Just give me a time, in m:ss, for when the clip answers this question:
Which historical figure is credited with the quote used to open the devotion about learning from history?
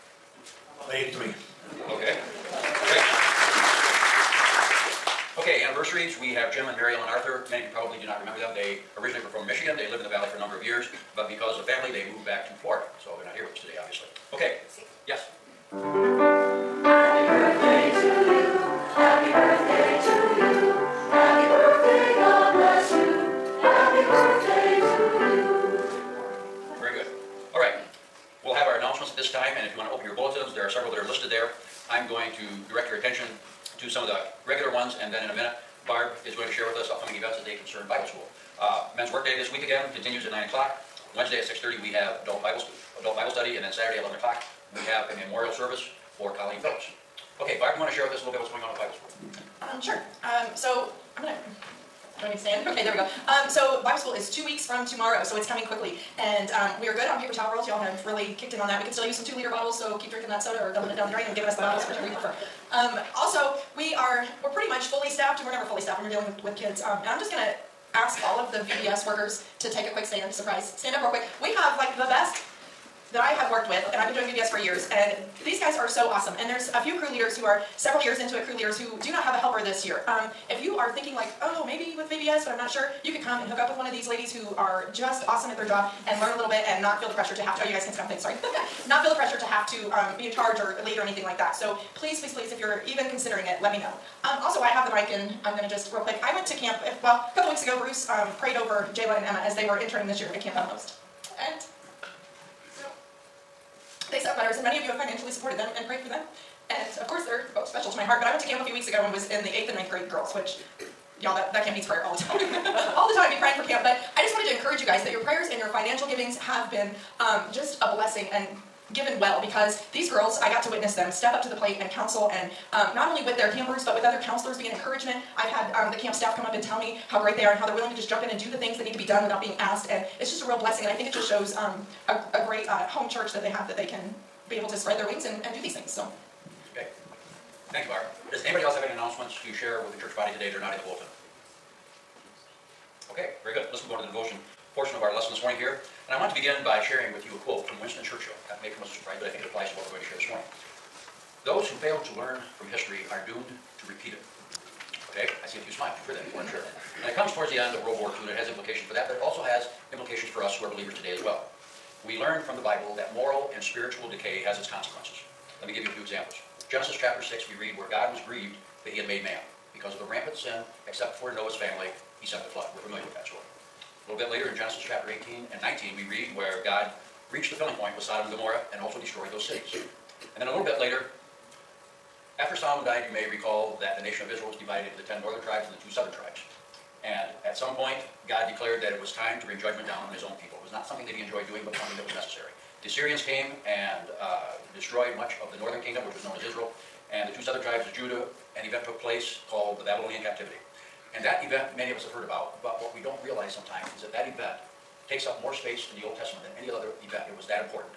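2:27.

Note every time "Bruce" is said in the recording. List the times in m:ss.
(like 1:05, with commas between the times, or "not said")
1:37.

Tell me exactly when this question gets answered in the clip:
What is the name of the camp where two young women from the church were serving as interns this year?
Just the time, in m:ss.
1:40.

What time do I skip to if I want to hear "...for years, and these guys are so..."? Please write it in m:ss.
1:14.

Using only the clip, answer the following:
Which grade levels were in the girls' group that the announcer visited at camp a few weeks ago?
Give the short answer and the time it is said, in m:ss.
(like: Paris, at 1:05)
eighth and ninth grade, at 1:49.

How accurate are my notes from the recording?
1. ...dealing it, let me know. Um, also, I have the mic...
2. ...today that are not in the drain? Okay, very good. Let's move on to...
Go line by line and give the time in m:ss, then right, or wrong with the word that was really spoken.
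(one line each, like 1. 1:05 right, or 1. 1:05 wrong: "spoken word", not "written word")
1. 1:33 wrong: "considering", not "dealing"
2. 2:20 wrong: "bulletin", not "drain".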